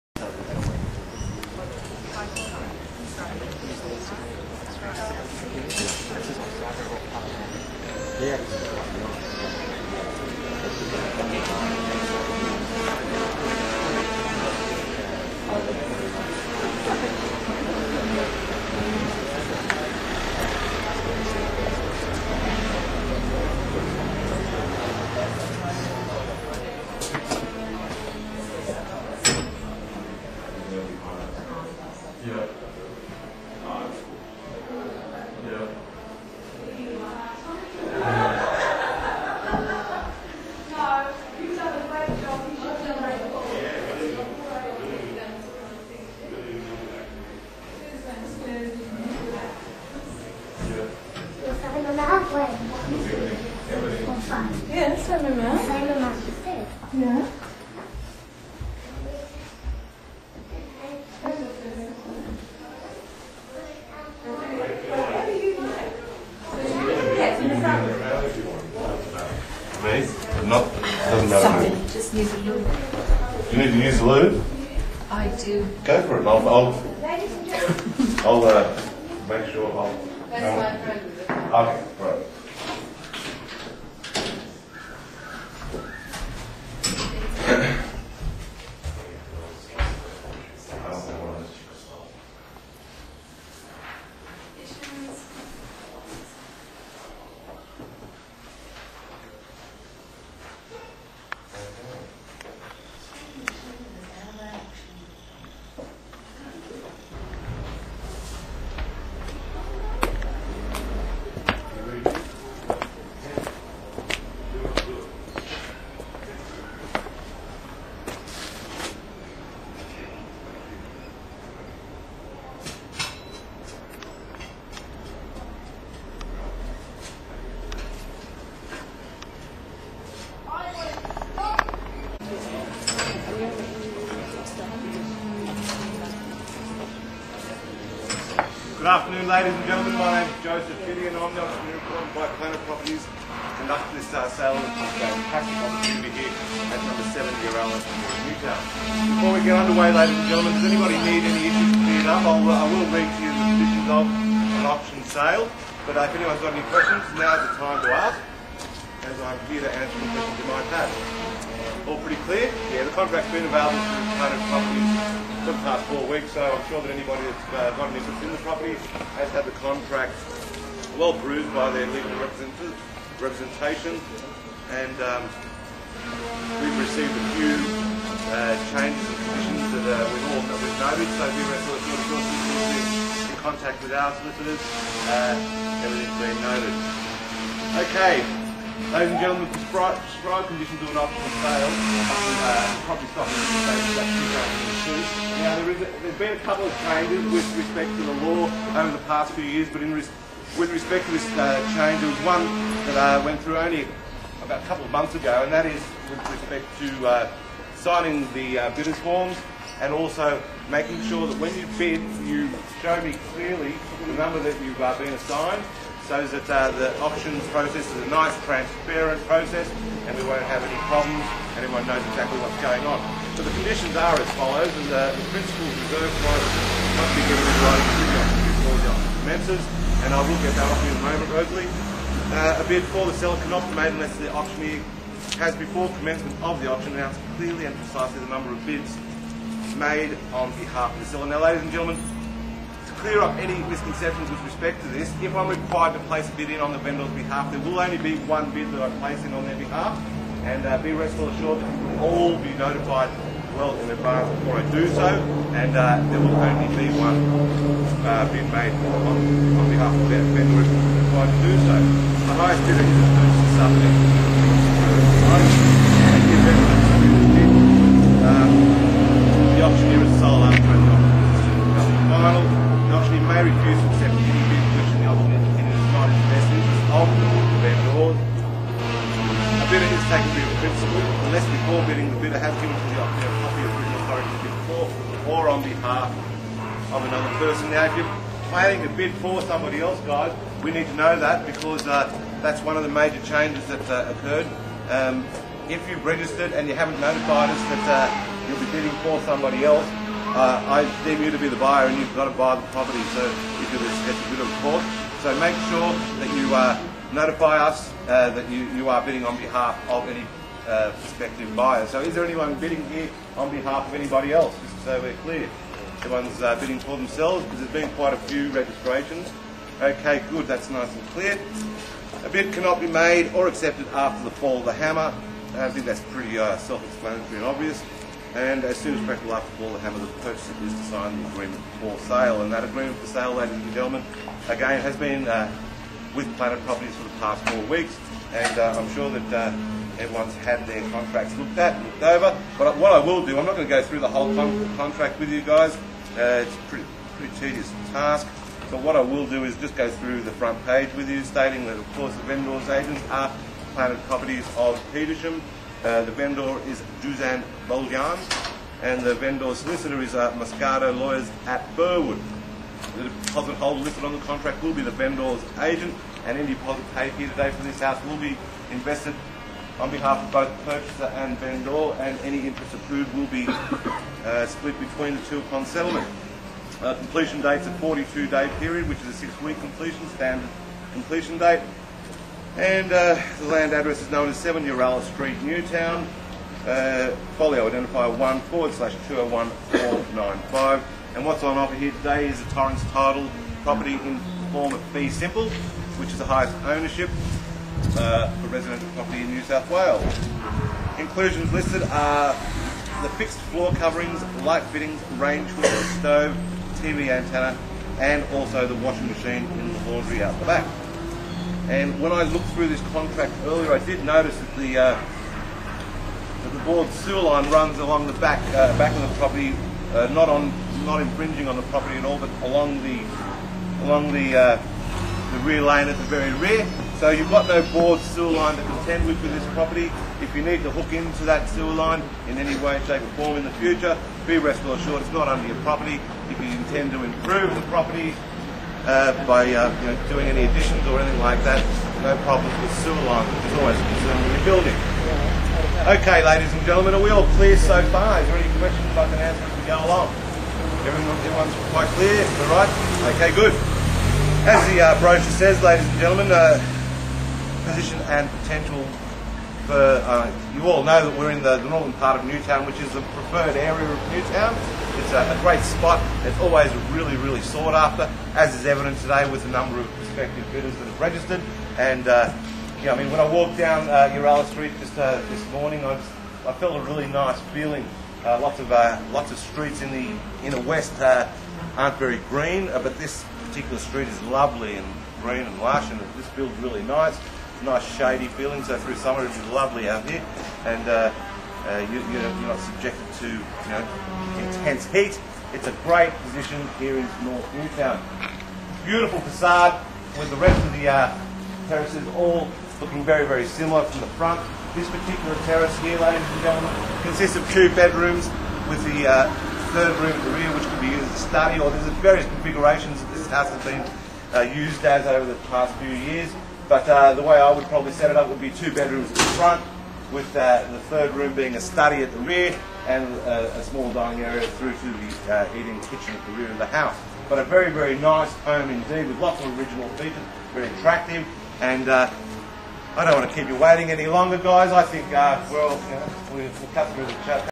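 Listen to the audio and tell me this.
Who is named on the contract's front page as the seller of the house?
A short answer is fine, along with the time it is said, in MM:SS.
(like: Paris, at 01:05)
Juzan Boljan, at 05:57.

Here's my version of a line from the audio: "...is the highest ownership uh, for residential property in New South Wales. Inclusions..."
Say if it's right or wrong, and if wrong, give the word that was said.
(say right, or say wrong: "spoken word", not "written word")
right.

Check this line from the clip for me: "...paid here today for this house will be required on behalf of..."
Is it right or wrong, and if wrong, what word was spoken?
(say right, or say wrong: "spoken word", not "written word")
wrong: "invested", not "required".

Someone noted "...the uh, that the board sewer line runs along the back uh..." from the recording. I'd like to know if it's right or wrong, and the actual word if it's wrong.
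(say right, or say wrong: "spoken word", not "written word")
right.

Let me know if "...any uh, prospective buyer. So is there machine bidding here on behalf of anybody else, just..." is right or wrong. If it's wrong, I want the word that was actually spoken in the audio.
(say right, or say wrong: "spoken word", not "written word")
wrong: "anyone", not "machine".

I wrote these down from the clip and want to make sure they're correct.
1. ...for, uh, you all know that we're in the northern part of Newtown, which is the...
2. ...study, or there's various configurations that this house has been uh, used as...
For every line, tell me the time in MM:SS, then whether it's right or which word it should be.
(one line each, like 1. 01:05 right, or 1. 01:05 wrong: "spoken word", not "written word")
1. 07:39 right
2. 08:31 right.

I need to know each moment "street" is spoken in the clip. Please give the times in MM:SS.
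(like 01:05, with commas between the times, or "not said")
06:25, 07:54, 07:59, 08:03.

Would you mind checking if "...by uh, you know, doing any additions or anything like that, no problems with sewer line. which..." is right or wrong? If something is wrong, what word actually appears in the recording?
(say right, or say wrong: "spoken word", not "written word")
right.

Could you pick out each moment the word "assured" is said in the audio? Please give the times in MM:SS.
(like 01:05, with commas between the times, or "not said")
04:11, 07:14.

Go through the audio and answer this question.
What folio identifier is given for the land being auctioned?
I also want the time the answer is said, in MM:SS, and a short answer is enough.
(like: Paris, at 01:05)
1/201495, at 06:28.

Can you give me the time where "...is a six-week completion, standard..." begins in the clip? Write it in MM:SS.
06:19.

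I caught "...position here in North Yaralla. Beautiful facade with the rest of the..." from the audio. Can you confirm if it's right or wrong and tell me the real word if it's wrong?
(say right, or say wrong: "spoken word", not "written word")
wrong: "Newtown", not "Yaralla".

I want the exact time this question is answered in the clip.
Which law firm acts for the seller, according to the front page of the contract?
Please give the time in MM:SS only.
06:00.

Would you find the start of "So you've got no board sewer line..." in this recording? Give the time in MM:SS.
07:07.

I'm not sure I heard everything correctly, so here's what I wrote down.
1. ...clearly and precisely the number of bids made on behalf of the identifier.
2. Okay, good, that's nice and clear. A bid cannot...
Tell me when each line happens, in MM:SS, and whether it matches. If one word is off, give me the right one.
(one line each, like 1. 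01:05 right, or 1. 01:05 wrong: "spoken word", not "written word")
1. 03:57 wrong: "seller", not "identifier"
2. 05:19 right.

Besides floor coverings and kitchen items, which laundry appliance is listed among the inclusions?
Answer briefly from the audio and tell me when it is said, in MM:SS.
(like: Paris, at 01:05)
washing machine, at 06:48.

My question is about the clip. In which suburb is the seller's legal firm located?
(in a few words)
Burwood.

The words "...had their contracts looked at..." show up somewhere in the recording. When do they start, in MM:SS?
05:40.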